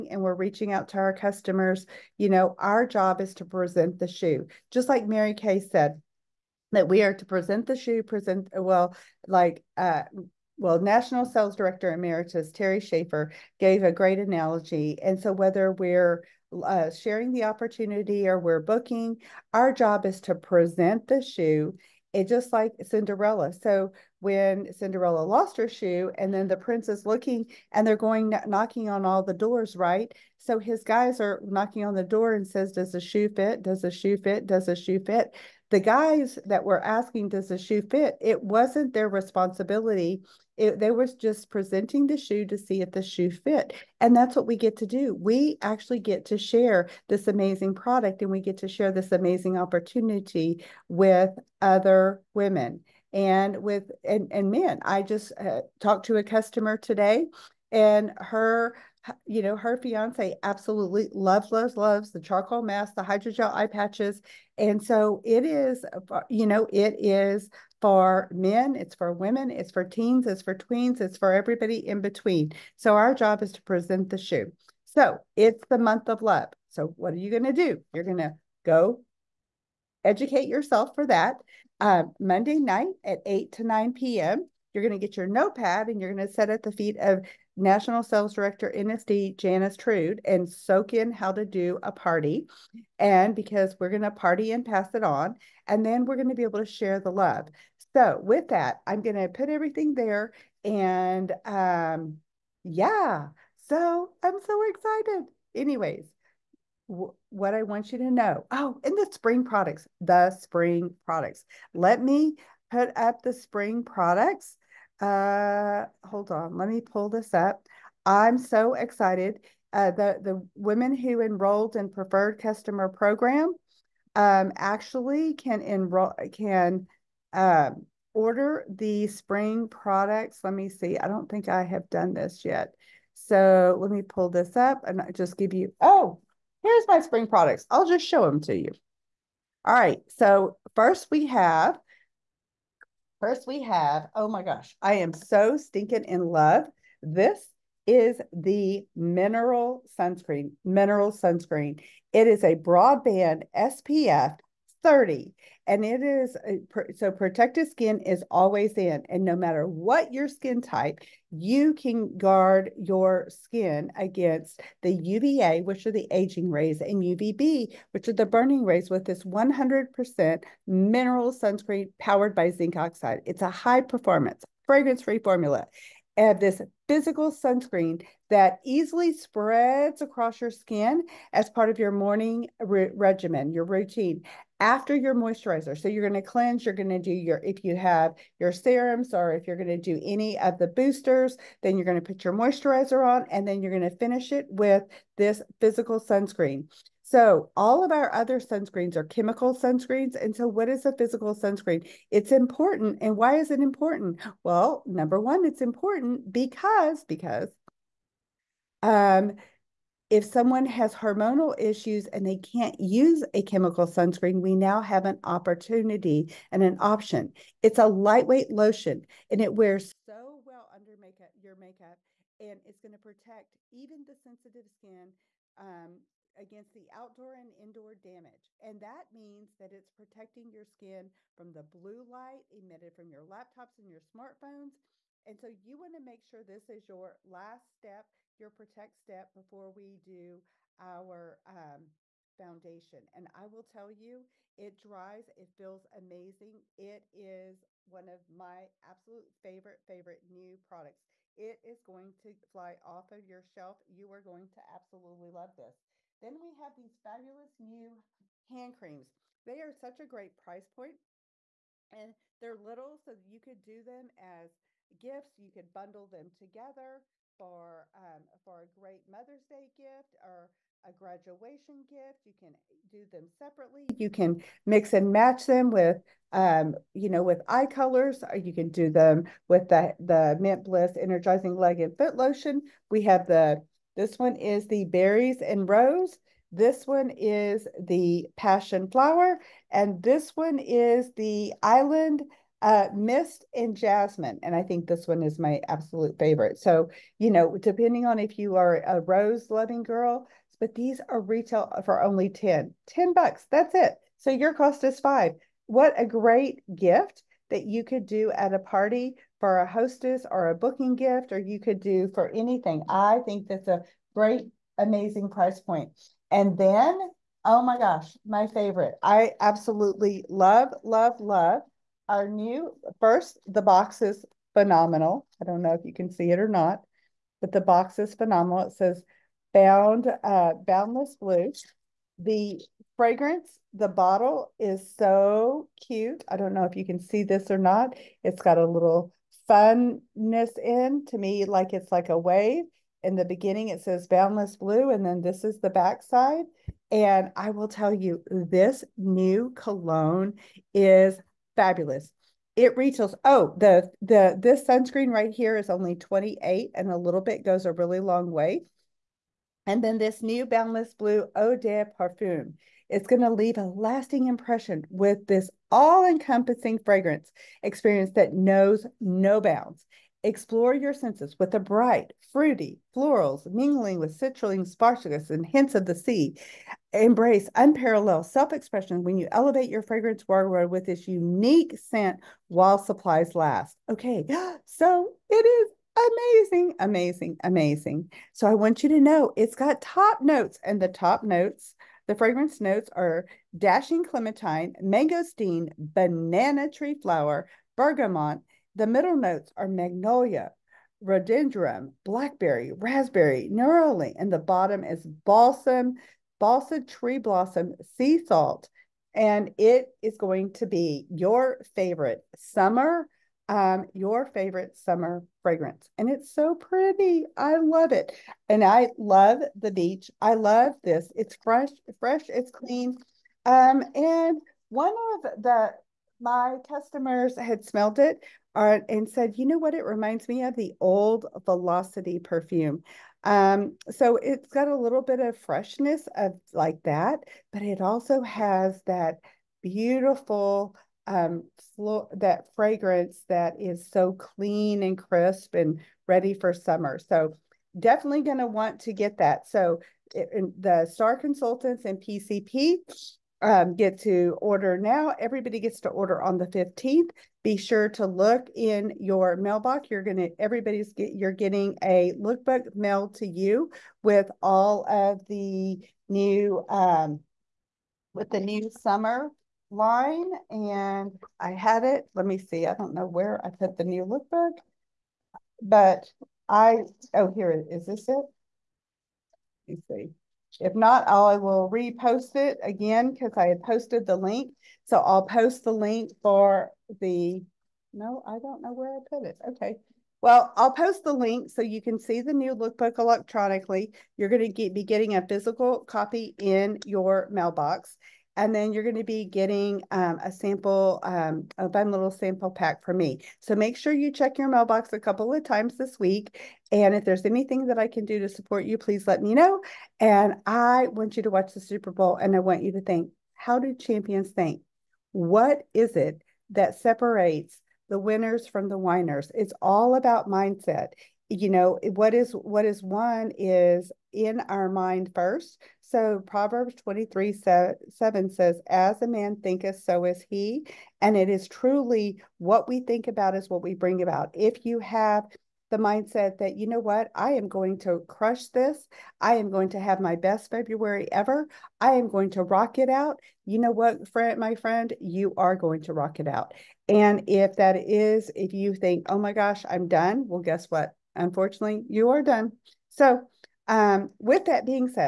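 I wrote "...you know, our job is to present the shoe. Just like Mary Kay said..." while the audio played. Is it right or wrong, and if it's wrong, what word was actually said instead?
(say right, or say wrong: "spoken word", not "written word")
right.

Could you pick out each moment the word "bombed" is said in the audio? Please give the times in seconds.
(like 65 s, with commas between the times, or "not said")
not said.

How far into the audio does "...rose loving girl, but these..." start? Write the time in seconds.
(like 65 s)
298 s.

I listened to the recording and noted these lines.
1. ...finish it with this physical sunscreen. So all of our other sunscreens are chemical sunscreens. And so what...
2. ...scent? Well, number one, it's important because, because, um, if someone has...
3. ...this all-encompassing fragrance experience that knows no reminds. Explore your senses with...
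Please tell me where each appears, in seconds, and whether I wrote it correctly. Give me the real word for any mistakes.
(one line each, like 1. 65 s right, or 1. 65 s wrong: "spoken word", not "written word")
1. 193 s right
2. 203 s wrong: "important", not "scent"
3. 365 s wrong: "bounds", not "reminds".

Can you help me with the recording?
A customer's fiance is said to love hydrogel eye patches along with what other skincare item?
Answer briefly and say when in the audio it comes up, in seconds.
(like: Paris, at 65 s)
charcoal mask, at 62 s.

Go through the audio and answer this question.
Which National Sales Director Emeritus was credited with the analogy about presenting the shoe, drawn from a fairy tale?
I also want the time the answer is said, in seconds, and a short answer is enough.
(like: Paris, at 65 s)
Terry Schaefer, at 12 s.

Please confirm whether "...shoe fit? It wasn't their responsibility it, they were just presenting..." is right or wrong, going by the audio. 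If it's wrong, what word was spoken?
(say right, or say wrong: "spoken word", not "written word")
right.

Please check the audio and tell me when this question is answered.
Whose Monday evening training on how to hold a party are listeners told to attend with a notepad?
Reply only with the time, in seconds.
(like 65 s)
89 s.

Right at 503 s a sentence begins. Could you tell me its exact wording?
So make sure you check your mailbox a couple of times this week.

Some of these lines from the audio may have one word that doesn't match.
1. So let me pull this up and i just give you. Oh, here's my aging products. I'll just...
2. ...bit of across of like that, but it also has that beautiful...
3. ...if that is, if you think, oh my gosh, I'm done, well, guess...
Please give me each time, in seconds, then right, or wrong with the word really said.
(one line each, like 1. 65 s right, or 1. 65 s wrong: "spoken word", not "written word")
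1. 133 s wrong: "spring", not "aging"
2. 435 s wrong: "freshness", not "across"
3. 547 s right.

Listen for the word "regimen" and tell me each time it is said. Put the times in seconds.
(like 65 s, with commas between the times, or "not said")
182 s.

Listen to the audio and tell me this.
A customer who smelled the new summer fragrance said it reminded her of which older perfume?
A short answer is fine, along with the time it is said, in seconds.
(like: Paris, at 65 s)
Velocity, at 431 s.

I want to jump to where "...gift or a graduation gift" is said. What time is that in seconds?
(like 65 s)
269 s.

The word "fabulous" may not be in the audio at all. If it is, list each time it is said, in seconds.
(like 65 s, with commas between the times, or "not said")
257 s, 351 s.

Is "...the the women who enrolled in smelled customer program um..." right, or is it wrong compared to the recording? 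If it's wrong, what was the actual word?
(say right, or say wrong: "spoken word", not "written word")
wrong: "preferred", not "smelled".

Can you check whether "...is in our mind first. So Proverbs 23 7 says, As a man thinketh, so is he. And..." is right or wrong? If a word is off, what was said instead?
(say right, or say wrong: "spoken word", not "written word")
right.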